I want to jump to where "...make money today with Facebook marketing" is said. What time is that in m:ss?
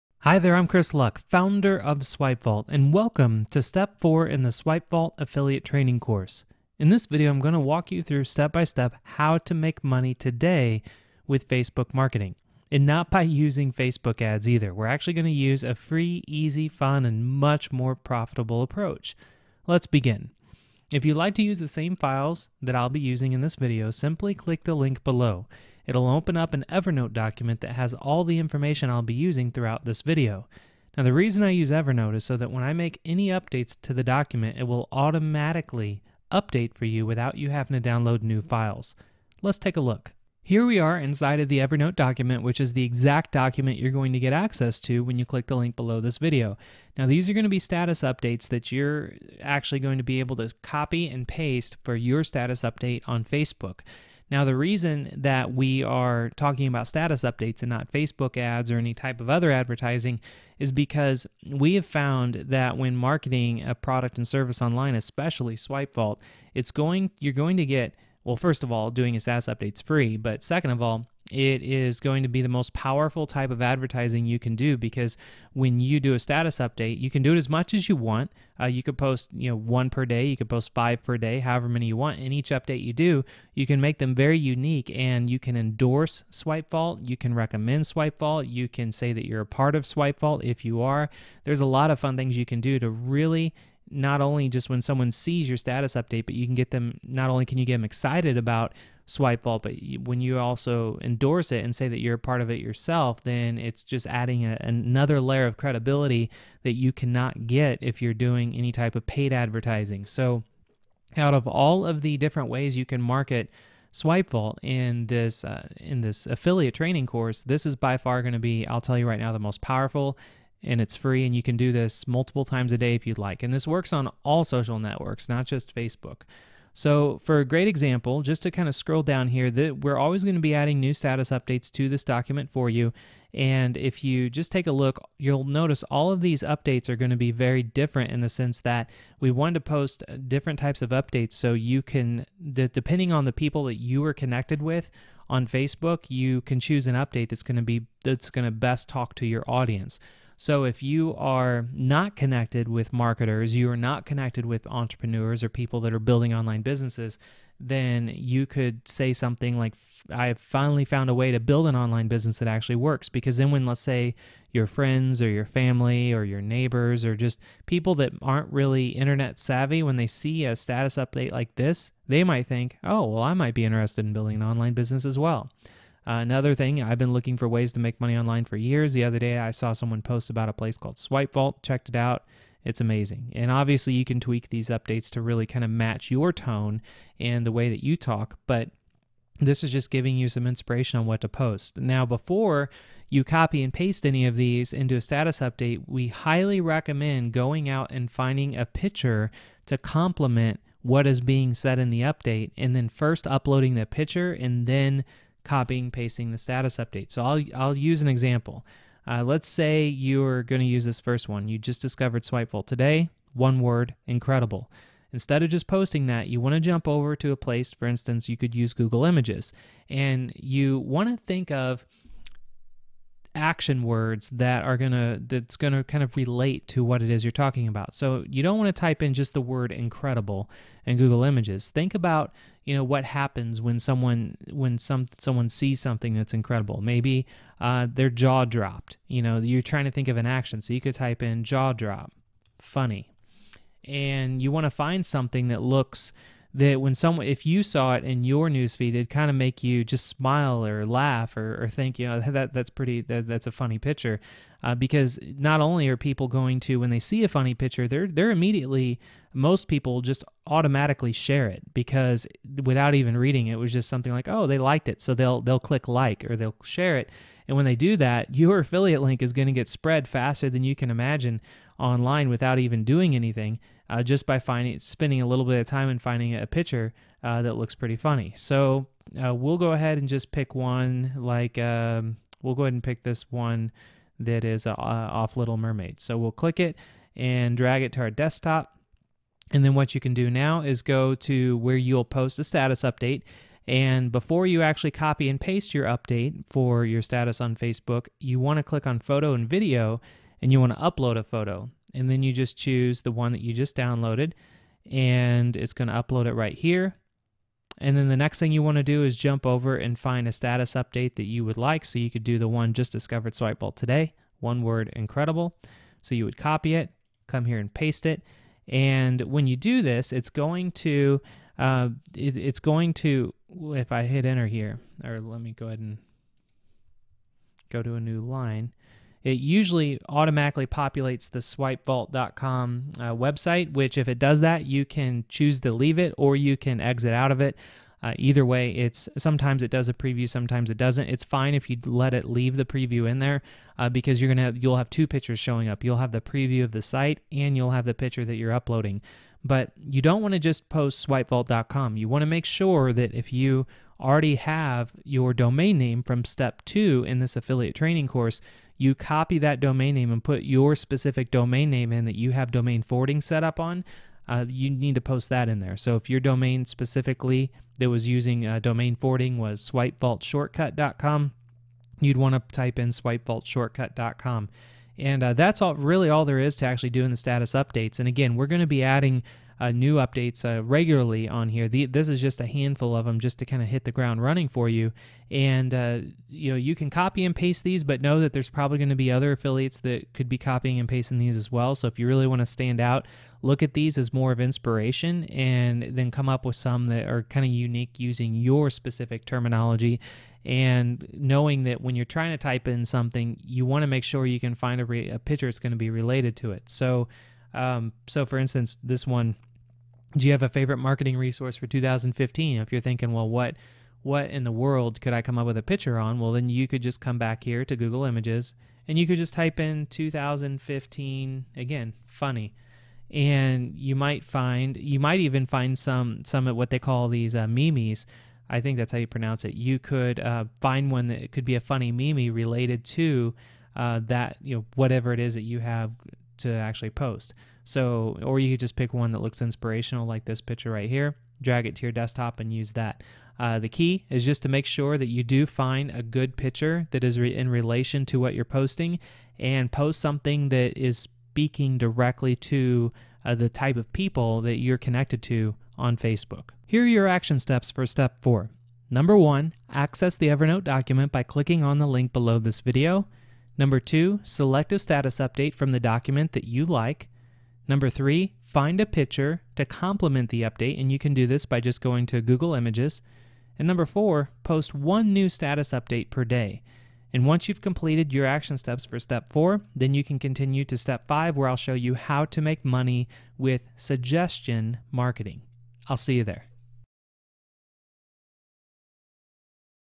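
0:09.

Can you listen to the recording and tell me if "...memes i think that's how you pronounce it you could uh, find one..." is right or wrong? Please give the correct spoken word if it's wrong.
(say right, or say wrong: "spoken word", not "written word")
right.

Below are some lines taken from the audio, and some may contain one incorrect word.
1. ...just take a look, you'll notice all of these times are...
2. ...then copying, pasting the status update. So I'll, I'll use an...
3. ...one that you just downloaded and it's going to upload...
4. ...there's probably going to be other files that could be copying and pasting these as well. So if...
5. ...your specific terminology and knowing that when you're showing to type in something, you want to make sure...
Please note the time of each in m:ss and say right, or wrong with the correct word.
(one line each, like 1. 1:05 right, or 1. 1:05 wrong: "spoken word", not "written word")
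1. 2:14 wrong: "updates", not "times"
2. 3:24 right
3. 5:03 right
4. 6:28 wrong: "affiliates", not "files"
5. 6:38 wrong: "trying", not "showing".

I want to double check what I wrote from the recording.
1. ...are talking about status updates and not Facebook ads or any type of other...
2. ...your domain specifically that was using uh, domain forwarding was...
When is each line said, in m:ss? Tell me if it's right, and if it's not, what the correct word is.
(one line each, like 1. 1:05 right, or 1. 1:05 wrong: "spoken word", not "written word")
1. 0:55 right
2. 6:06 right.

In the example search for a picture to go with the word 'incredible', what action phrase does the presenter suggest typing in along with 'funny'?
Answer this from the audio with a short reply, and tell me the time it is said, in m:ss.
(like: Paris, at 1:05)
jaw drop, at 4:01.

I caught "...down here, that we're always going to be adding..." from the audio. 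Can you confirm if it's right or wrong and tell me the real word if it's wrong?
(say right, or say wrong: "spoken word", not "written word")
right.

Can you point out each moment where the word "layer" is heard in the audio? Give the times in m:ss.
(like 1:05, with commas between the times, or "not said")
1:45.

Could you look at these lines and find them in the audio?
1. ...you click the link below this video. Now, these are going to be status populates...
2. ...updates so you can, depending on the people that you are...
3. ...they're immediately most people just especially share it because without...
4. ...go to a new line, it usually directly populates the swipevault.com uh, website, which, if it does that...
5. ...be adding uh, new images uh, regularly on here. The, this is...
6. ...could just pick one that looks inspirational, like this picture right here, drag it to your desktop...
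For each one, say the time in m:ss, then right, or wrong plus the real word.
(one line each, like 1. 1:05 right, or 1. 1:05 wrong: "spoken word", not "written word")
1. 0:45 wrong: "updates", not "populates"
2. 2:20 right
3. 4:18 wrong: "automatically", not "especially"
4. 5:27 wrong: "automatically", not "directly"
5. 6:18 wrong: "updates", not "images"
6. 7:18 right.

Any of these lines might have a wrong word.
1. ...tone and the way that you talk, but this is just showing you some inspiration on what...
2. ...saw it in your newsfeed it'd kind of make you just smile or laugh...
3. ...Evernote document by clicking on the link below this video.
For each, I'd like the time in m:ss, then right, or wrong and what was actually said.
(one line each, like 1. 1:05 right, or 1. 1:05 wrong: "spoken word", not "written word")
1. 3:06 wrong: "giving", not "showing"
2. 4:07 right
3. 7:40 right.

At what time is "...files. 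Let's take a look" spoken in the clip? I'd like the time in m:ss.
0:38.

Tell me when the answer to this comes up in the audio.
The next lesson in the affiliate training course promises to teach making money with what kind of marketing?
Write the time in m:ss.
8:03.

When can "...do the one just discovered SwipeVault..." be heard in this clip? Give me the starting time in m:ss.
5:12.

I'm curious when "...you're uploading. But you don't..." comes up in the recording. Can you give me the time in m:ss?
5:48.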